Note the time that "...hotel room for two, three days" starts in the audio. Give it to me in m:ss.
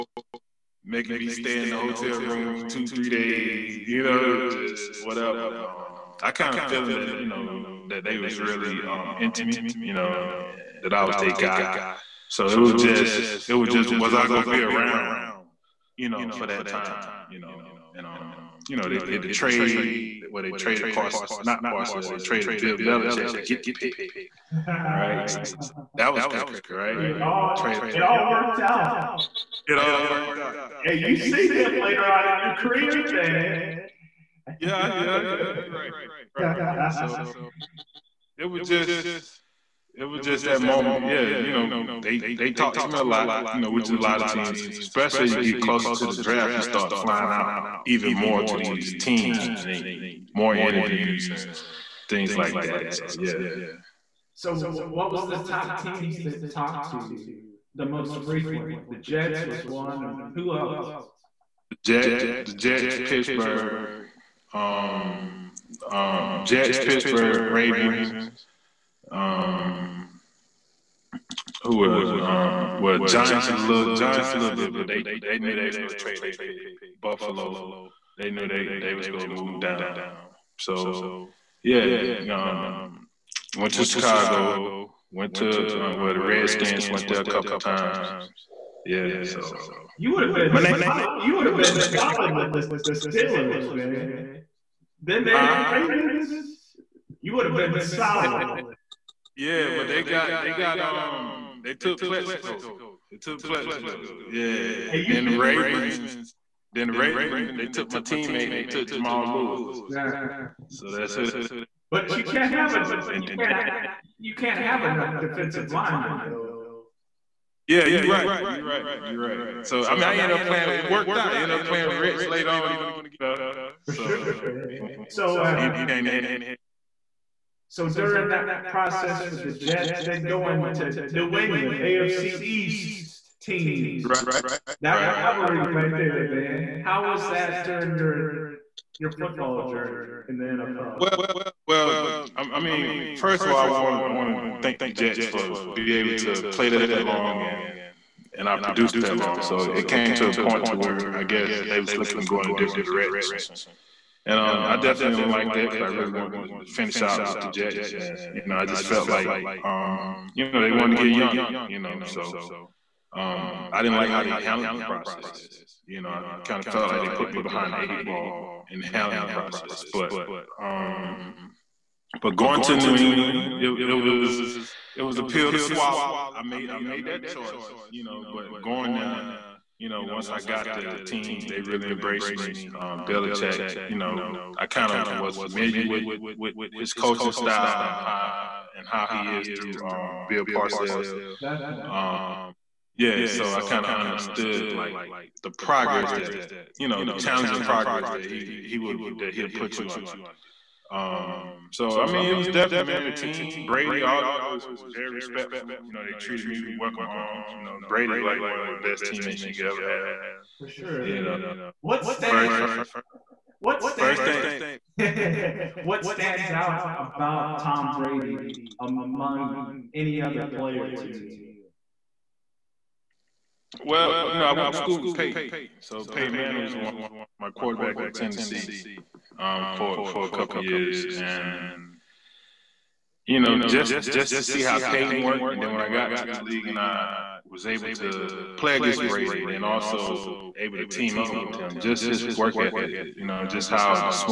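0:01.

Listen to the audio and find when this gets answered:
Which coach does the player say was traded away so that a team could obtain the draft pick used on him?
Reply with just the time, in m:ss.
0:22.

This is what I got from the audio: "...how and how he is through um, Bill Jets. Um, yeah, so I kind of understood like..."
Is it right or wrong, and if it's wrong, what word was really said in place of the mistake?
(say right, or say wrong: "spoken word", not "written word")
wrong: "Parcells", not "Jets".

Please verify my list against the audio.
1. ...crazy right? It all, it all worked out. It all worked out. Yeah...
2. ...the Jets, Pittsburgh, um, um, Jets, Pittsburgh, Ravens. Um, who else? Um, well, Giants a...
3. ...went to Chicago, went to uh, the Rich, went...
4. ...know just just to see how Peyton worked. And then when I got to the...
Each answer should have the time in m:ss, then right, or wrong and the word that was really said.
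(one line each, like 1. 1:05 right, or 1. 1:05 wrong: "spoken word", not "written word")
1. 0:26 right
2. 1:02 right
3. 1:23 wrong: "Redskins", not "Rich"
4. 3:53 right.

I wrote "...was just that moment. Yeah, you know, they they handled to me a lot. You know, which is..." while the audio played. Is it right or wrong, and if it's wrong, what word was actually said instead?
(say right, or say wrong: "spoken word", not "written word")
wrong: "talked", not "handled".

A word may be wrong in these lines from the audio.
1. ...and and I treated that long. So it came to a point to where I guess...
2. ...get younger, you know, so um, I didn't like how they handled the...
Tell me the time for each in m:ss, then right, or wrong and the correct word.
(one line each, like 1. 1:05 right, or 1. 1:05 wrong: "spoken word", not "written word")
1. 2:27 wrong: "produced", not "treated"
2. 2:41 right.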